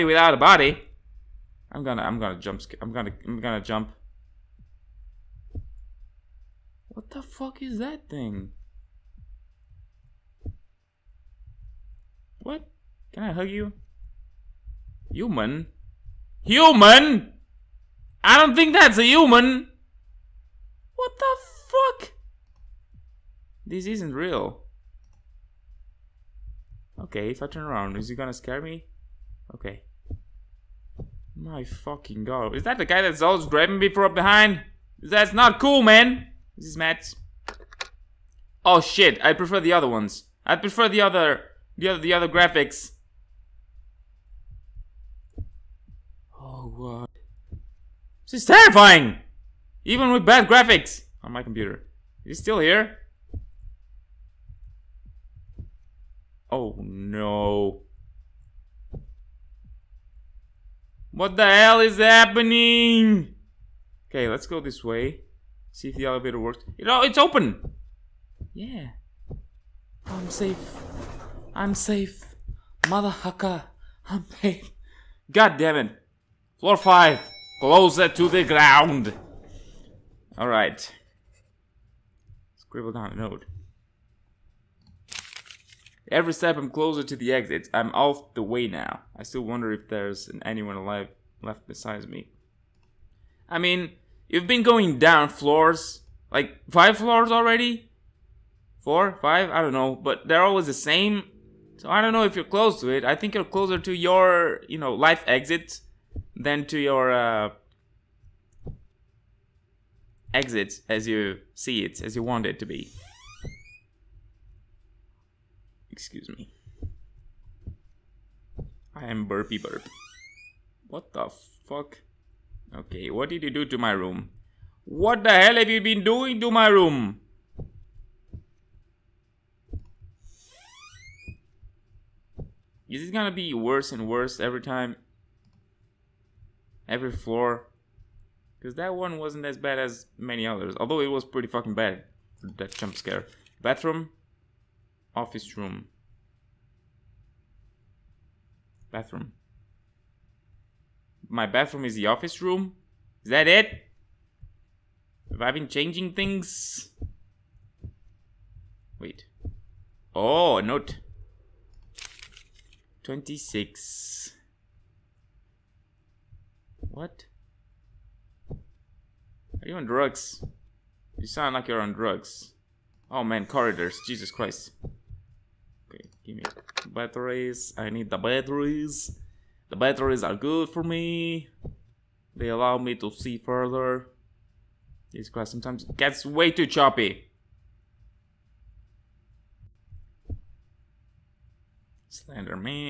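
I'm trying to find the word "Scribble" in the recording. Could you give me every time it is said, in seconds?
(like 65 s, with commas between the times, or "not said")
82 s.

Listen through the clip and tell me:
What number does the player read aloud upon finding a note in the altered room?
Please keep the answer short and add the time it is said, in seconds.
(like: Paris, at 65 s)
26, at 163 s.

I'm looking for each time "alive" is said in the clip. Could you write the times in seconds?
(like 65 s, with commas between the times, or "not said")
90 s.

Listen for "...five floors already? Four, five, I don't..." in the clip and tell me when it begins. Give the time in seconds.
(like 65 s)
96 s.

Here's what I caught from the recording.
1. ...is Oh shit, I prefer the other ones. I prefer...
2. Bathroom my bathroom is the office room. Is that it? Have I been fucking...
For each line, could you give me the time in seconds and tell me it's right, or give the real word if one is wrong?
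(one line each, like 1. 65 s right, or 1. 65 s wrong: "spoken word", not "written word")
1. 36 s right
2. 148 s wrong: "changing", not "fucking".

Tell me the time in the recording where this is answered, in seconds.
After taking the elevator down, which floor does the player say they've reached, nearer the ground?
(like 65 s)
76 s.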